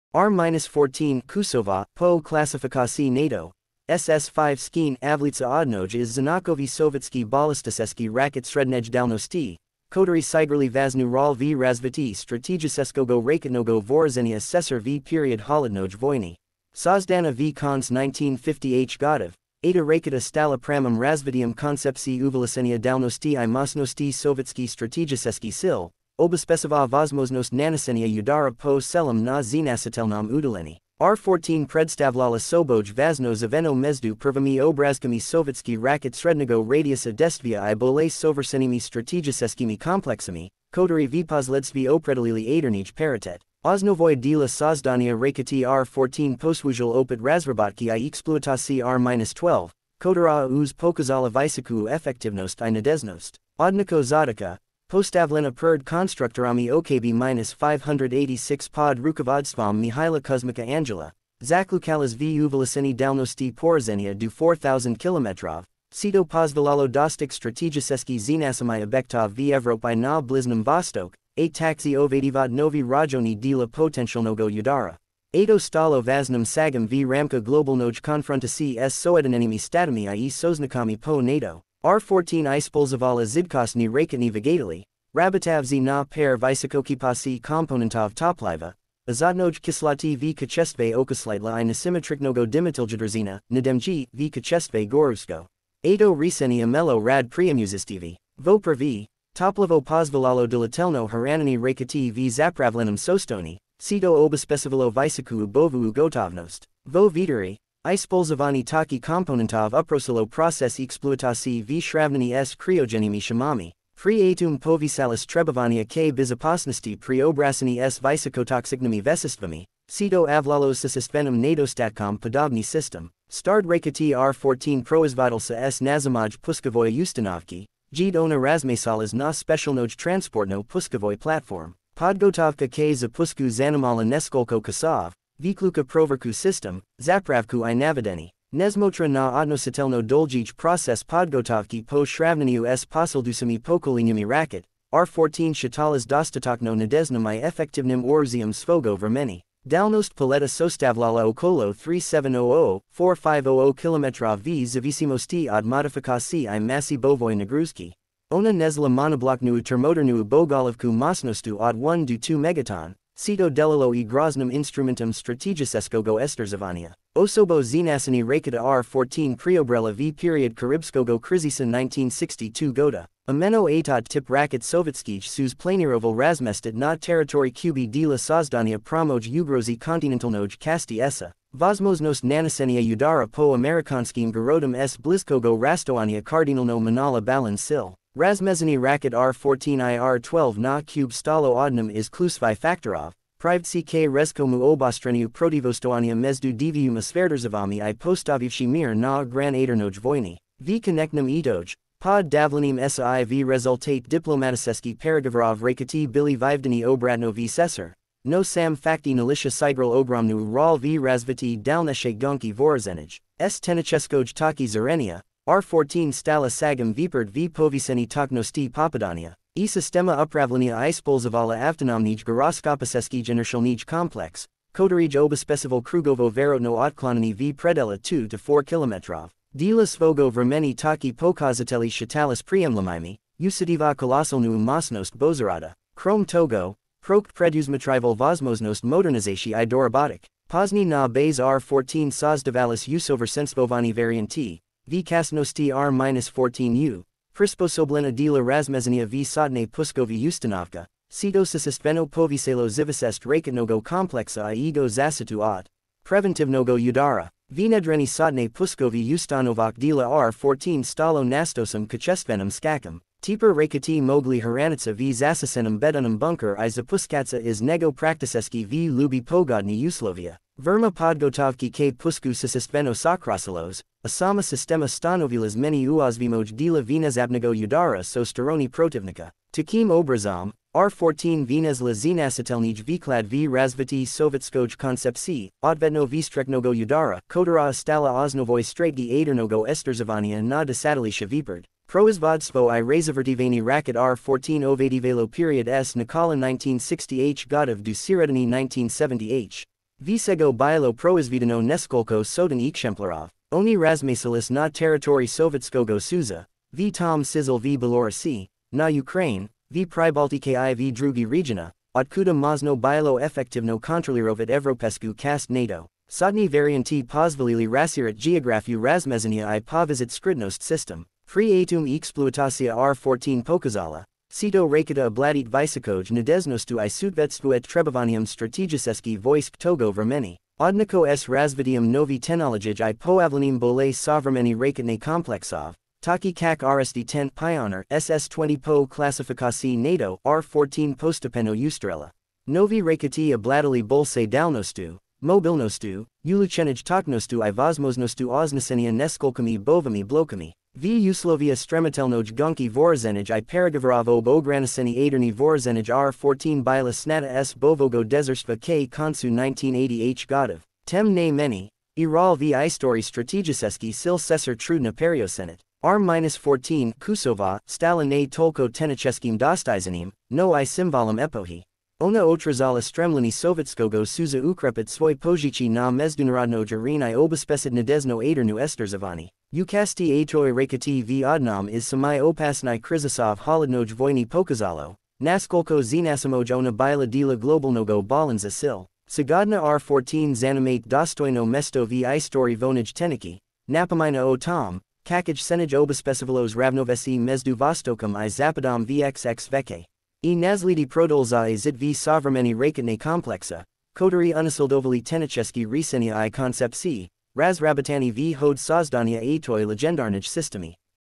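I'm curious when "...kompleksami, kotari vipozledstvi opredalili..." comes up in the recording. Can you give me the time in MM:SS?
00:39.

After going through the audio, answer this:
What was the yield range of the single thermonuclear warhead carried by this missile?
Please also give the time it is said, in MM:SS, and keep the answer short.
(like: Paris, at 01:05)
1 to 2 megatons, at 02:41.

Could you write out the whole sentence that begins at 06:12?
Ona otrazala stremleni sovetskogo suza ukrepit svoj pozici na mezdunarodno jarinai obespesid nadezno adernu esterzavani.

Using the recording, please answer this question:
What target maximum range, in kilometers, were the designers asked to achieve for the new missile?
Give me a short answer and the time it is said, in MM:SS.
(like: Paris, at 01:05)
4000 km, at 01:04.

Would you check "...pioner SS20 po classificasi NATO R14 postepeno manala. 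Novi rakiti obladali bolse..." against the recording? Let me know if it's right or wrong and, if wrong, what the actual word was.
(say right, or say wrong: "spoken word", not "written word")
wrong: "ustrela", not "manala".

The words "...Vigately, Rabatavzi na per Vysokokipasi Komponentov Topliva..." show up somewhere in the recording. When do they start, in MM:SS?
01:24.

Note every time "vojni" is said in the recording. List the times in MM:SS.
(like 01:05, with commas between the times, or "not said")
00:15, 03:19, 06:23.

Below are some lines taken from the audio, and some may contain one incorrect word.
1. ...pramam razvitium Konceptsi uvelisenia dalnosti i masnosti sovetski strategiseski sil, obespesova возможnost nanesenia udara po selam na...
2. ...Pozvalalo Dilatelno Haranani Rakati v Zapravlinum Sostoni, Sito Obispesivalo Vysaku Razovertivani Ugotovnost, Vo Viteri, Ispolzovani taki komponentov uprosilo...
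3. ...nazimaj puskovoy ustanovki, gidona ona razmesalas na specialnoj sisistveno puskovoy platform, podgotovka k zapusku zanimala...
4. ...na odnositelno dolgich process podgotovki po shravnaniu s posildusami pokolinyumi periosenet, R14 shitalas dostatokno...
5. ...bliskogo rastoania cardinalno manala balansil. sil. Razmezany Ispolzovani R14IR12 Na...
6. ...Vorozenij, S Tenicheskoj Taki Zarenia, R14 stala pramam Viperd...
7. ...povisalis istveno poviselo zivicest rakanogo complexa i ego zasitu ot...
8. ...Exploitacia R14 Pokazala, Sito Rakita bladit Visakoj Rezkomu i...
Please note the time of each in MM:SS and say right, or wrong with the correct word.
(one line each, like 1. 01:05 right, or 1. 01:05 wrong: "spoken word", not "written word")
1. 00:20 right
2. 01:39 wrong: "Ubovu", not "Razovertivani"
3. 02:05 wrong: "transportno", not "sisistveno"
4. 02:19 wrong: "racket", not "periosenet"
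5. 03:04 wrong: "Racket", not "Ispolzovani"
6. 03:32 wrong: "sagam", not "pramam"
7. 04:11 wrong: "cetosis", not "povisalis"
8. 05:21 wrong: "Nadeznostu", not "Rezkomu".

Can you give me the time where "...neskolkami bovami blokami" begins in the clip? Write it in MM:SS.
05:48.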